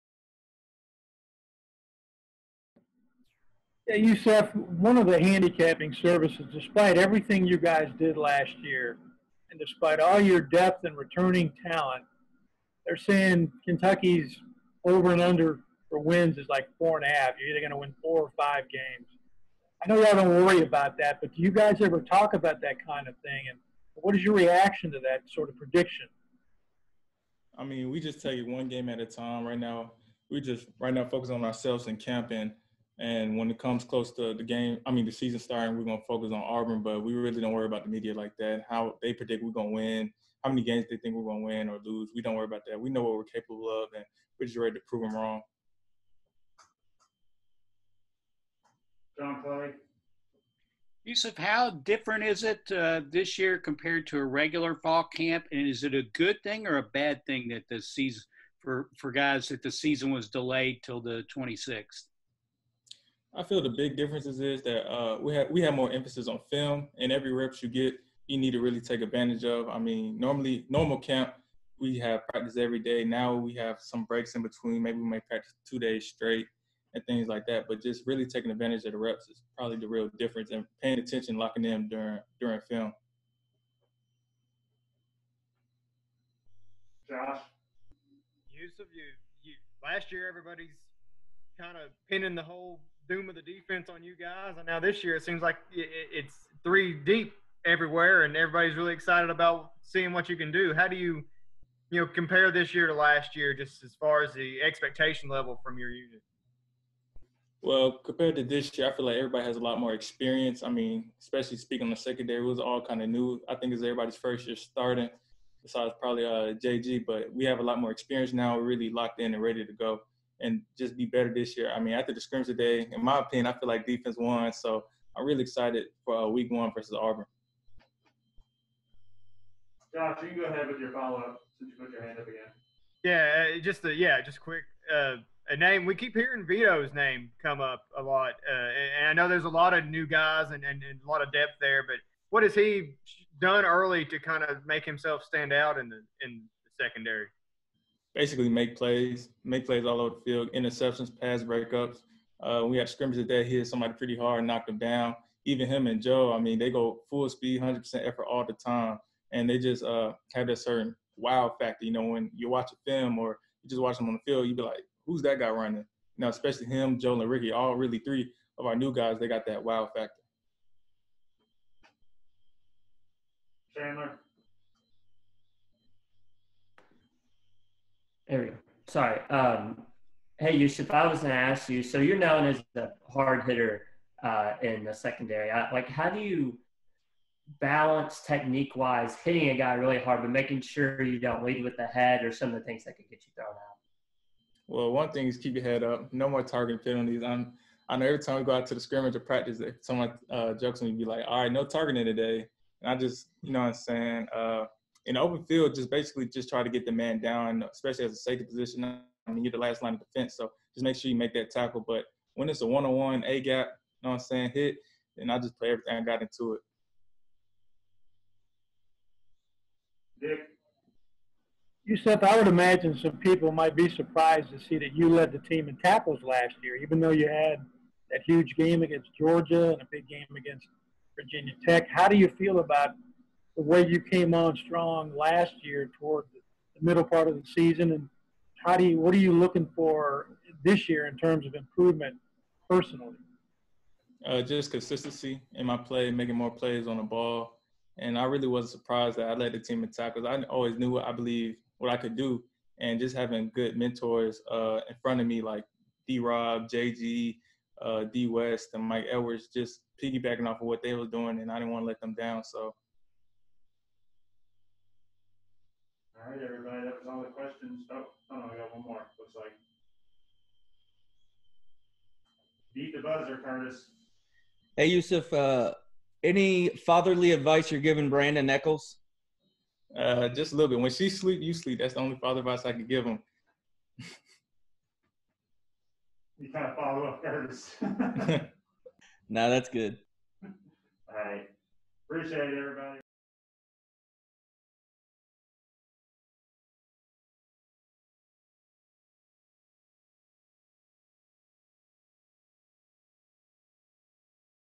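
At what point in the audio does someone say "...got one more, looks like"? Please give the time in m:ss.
4:28.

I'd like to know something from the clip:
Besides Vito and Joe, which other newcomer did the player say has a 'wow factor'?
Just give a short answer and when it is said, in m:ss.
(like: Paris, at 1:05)
Ricky, at 2:47.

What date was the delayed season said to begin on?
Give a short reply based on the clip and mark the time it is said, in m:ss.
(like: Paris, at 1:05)
the 26th, at 1:01.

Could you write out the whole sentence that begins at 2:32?
Uh, we had scrimmages that hit somebody pretty hard, knocked them down.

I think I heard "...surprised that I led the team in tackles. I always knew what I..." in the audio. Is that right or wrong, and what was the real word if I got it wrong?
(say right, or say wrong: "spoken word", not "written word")
right.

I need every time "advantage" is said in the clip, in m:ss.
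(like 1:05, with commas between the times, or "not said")
1:09, 1:18.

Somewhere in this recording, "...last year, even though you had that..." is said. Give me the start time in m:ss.
3:46.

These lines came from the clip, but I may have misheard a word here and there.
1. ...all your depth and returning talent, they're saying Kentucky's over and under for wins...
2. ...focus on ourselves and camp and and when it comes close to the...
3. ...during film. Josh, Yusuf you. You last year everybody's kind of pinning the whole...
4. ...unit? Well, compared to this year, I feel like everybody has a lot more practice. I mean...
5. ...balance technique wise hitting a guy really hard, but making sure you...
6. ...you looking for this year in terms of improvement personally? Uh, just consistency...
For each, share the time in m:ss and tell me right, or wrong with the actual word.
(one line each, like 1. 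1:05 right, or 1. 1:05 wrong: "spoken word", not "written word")
1. 0:09 right
2. 0:31 right
3. 1:22 right
4. 1:45 wrong: "experience", not "practice"
5. 3:07 right
6. 3:59 right.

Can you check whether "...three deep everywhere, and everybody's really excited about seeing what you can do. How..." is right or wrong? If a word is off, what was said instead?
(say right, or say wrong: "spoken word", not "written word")
right.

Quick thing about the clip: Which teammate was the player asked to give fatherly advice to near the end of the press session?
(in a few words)
Brandon Echols.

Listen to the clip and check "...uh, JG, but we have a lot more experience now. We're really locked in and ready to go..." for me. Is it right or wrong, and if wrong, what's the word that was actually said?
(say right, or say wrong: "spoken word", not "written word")
right.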